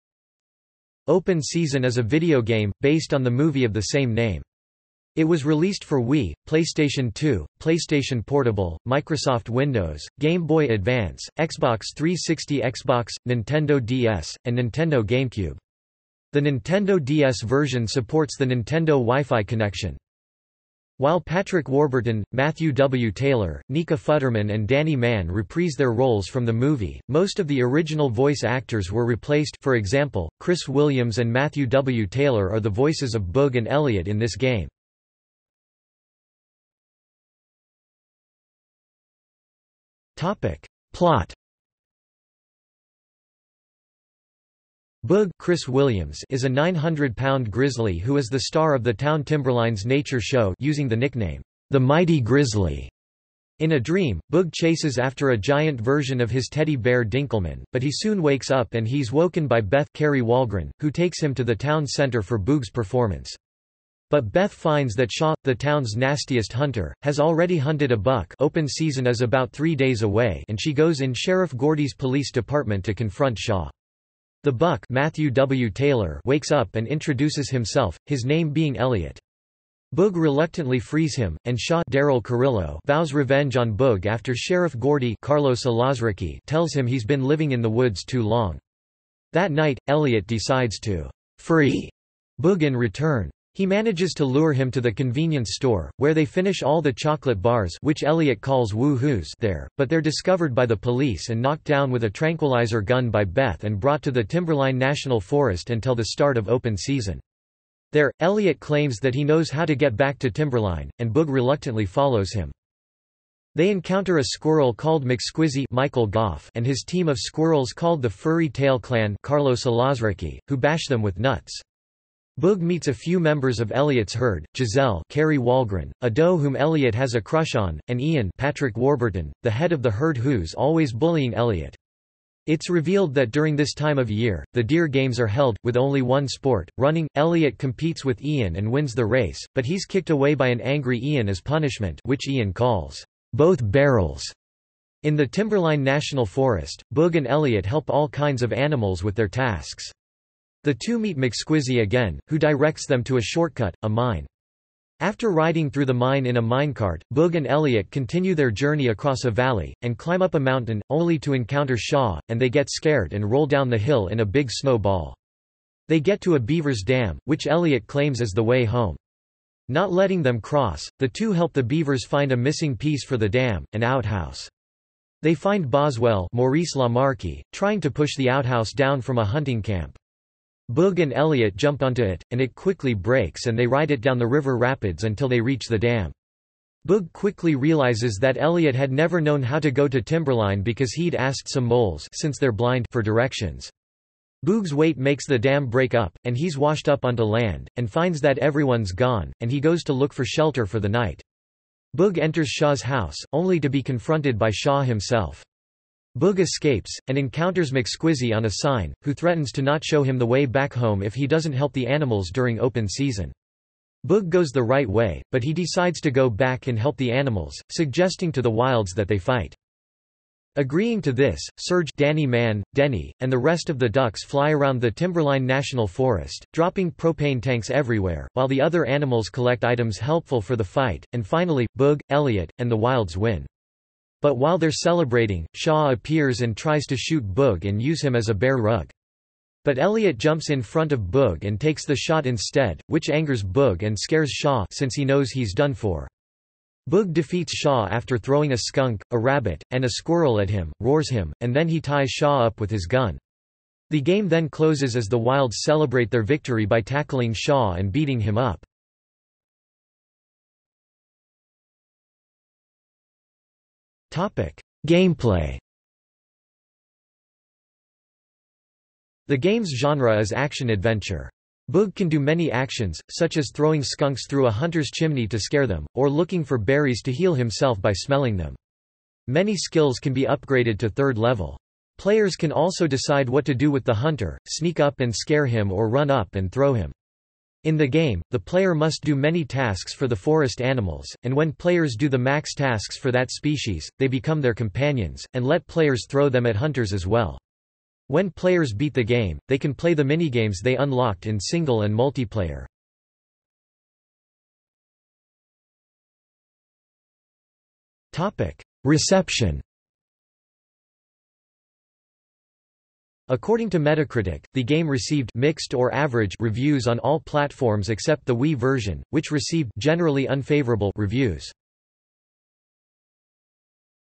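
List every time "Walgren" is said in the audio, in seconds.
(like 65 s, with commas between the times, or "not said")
60 s, 125 s.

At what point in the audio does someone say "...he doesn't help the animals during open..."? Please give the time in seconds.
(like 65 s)
211 s.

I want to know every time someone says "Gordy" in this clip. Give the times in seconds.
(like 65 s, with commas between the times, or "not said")
71 s, 84 s.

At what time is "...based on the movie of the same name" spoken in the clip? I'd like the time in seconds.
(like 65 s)
2 s.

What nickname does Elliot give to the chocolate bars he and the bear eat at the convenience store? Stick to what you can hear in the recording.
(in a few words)
woo-hoos.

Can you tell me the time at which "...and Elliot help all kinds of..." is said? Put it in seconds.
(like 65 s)
147 s.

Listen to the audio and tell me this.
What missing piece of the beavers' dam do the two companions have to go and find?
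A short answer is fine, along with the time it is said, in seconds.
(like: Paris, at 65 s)
an outhouse, at 173 s.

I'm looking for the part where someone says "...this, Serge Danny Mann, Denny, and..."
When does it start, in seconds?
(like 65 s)
221 s.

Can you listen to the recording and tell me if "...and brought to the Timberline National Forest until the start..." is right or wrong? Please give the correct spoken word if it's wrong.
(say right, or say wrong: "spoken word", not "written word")
right.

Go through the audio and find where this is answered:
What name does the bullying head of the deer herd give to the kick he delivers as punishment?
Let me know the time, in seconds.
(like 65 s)
143 s.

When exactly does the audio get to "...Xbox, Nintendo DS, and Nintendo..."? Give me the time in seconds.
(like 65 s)
12 s.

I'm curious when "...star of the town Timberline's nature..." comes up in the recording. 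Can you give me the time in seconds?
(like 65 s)
48 s.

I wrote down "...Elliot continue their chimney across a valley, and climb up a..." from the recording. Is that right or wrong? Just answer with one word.
wrong.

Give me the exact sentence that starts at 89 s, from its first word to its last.
That night, Elliot decides to free Boog in return.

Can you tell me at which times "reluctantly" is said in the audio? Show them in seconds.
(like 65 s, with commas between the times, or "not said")
80 s, 111 s.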